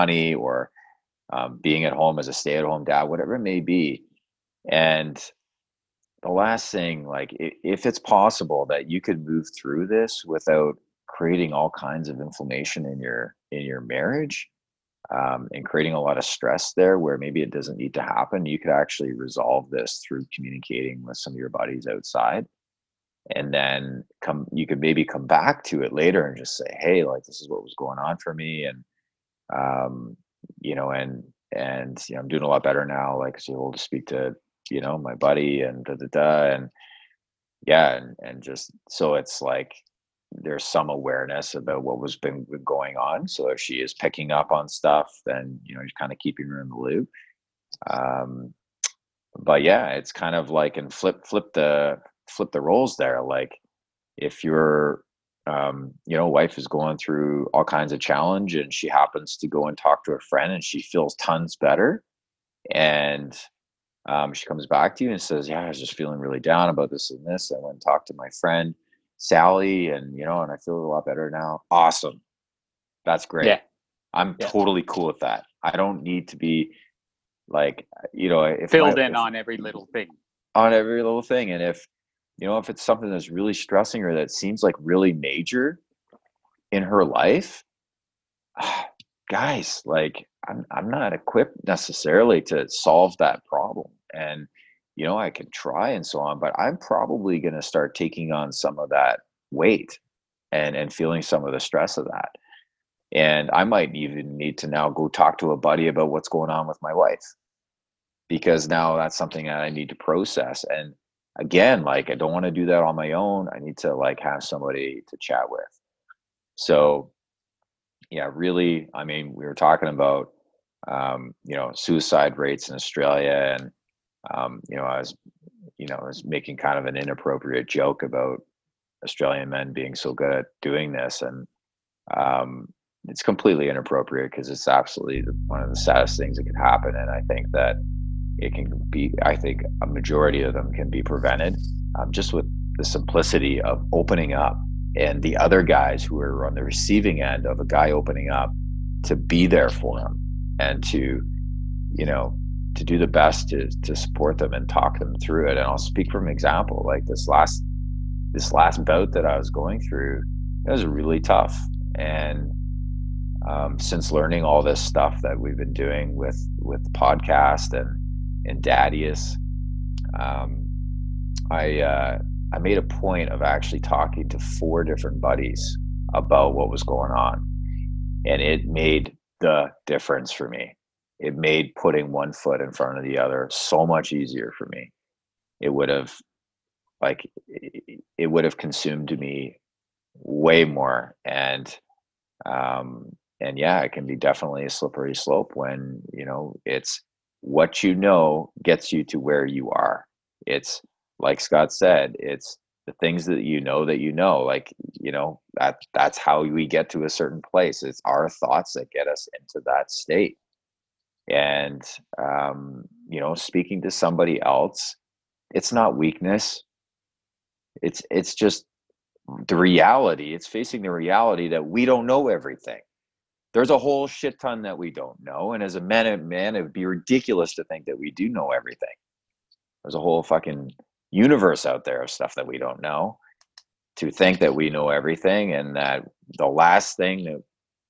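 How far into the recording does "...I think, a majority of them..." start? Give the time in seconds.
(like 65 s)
139 s.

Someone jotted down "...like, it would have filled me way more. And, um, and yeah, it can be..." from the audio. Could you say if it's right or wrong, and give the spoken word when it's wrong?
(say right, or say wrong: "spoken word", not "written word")
wrong: "consumed", not "filled".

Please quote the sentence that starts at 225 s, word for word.
And as a man, man, it would be ridiculous to think that we do know everything.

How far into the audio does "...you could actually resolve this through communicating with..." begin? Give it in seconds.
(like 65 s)
18 s.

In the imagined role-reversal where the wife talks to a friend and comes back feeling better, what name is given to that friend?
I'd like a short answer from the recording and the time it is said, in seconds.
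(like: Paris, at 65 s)
Sally, at 69 s.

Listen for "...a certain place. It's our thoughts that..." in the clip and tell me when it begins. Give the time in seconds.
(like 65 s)
207 s.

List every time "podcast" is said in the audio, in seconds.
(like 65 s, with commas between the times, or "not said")
166 s.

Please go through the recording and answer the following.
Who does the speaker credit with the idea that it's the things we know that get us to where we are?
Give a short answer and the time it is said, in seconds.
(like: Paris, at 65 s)
Scott, at 201 s.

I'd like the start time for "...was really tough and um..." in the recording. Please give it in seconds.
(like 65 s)
160 s.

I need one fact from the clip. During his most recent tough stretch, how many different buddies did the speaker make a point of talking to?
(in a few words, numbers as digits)
4.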